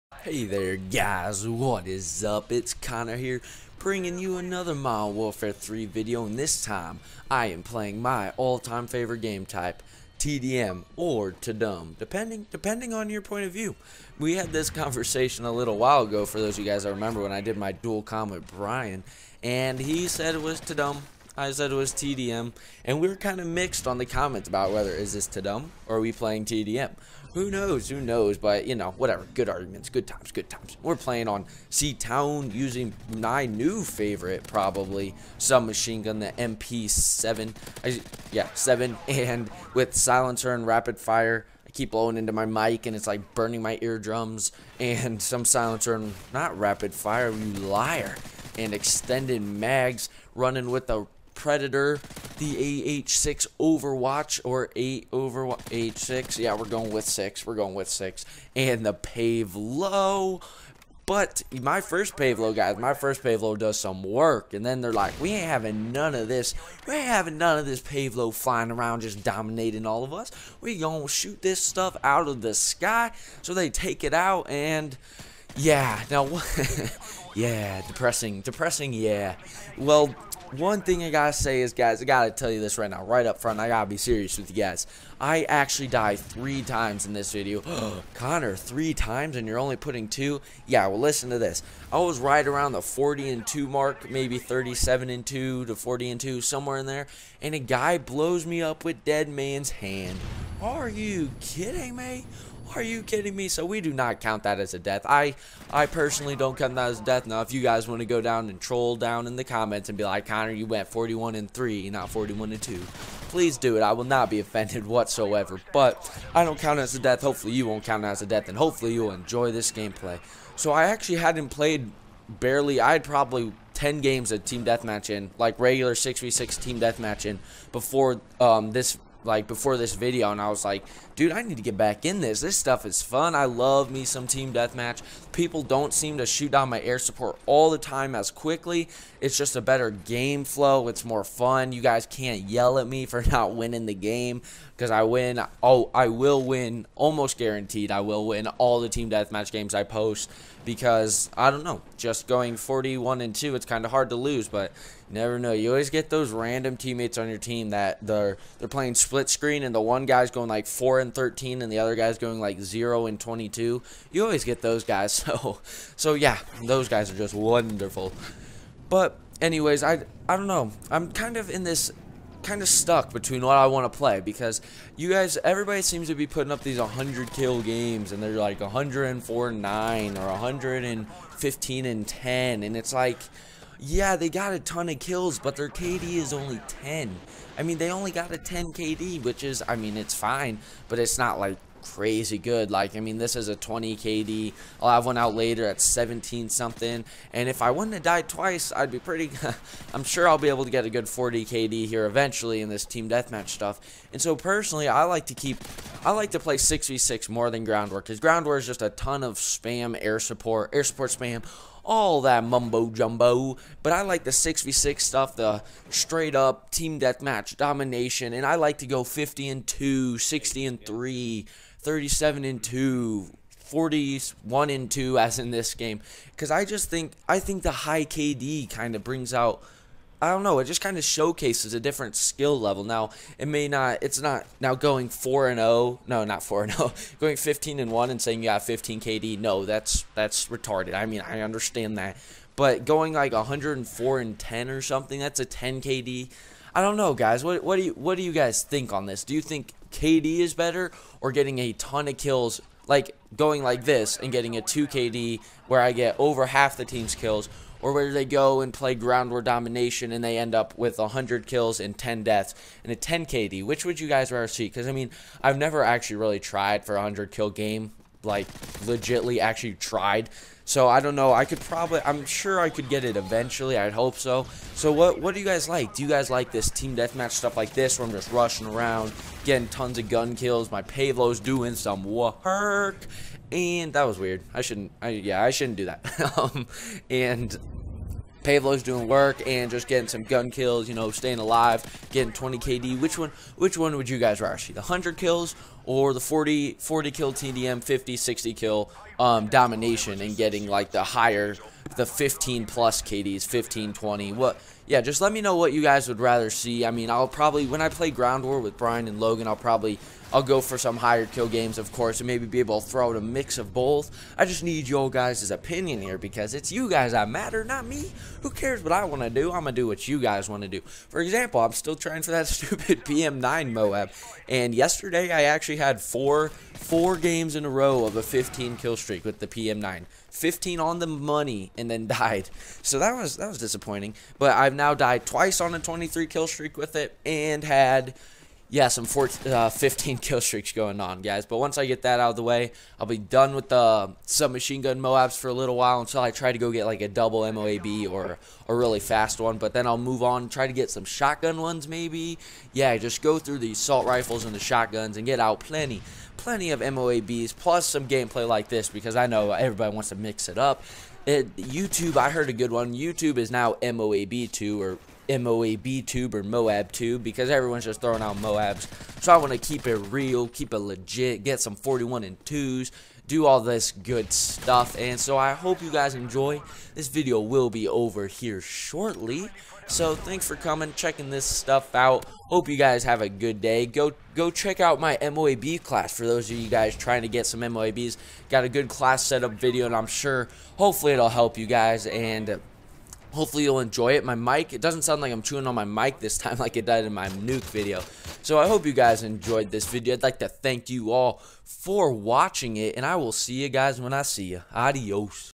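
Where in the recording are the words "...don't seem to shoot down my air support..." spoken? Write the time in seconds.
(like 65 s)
135 s.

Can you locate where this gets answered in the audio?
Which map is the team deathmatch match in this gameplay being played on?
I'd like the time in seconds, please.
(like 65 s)
31 s.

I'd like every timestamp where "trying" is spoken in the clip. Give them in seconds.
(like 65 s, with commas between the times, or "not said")
321 s, 386 s.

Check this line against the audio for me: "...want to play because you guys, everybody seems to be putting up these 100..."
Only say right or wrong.
right.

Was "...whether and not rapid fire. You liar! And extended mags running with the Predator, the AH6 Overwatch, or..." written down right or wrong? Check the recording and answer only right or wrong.
wrong.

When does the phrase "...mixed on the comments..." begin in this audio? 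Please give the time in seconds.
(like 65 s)
23 s.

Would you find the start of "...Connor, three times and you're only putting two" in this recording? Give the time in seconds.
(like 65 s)
88 s.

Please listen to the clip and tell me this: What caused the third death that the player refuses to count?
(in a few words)
Dead Man's Hand.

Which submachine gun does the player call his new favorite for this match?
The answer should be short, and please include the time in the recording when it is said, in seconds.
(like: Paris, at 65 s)
MP7, at 36 s.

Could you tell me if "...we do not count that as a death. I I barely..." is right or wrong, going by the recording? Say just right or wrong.
wrong.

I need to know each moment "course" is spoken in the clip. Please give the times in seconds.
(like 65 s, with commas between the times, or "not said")
311 s.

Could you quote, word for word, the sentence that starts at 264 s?
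Because, I mean, I've never actually really tried for a 100 kill game like legitly actually tried.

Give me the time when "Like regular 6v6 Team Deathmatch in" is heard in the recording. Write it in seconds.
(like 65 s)
125 s.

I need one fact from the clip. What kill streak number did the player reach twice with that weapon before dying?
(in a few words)
23.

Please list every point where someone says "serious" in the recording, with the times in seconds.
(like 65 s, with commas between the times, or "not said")
83 s.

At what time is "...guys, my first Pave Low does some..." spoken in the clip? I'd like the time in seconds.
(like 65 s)
62 s.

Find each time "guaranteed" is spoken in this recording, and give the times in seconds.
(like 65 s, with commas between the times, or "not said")
147 s.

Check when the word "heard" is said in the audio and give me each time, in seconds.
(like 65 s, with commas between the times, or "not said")
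362 s.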